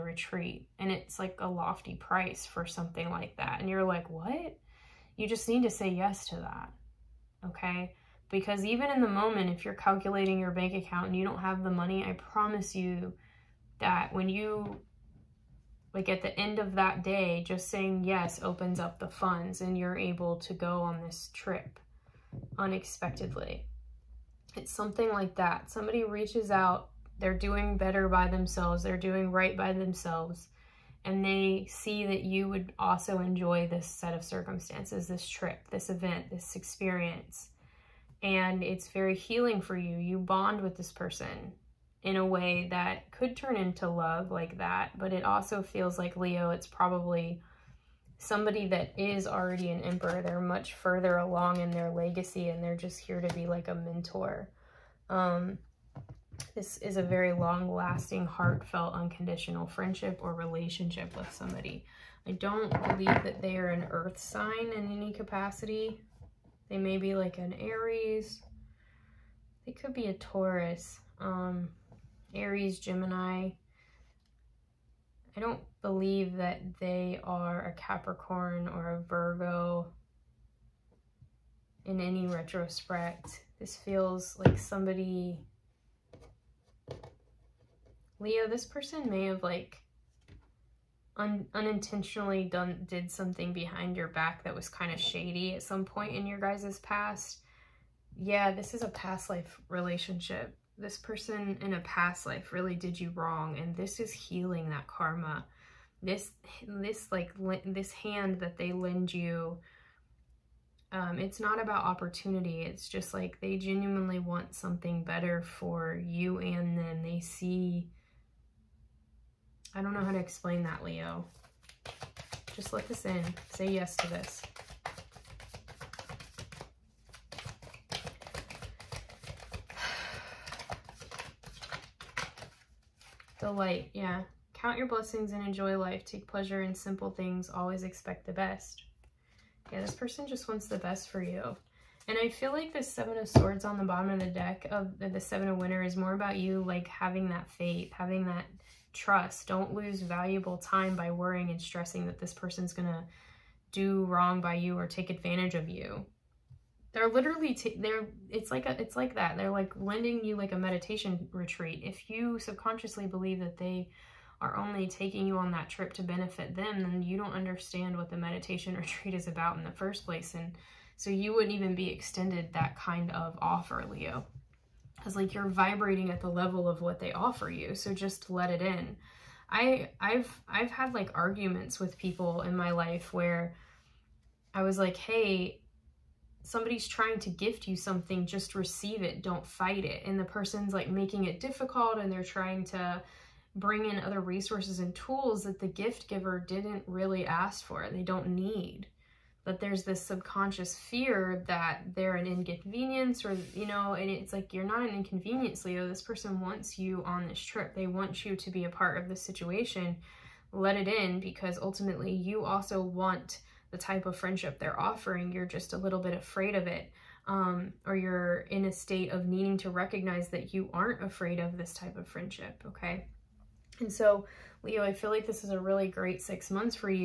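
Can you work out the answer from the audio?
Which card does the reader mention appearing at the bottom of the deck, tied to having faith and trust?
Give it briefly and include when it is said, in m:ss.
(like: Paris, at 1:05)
Seven of Swords, at 2:22.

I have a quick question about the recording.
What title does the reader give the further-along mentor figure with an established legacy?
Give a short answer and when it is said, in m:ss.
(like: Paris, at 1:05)
Emperor, at 0:49.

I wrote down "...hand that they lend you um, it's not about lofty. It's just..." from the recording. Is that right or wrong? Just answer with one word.
wrong.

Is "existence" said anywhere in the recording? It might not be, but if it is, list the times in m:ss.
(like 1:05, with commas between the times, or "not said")
not said.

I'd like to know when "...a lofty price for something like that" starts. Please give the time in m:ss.
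0:01.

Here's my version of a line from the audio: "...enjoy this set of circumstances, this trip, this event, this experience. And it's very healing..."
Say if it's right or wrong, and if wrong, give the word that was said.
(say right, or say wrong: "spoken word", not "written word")
right.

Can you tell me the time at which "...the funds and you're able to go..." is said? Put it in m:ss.
0:18.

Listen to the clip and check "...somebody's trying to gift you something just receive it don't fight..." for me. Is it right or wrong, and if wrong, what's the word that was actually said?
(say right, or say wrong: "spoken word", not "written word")
right.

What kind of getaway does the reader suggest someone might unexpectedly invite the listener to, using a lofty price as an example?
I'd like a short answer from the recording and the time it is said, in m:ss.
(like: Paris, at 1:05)
Meditation retreat, at 2:40.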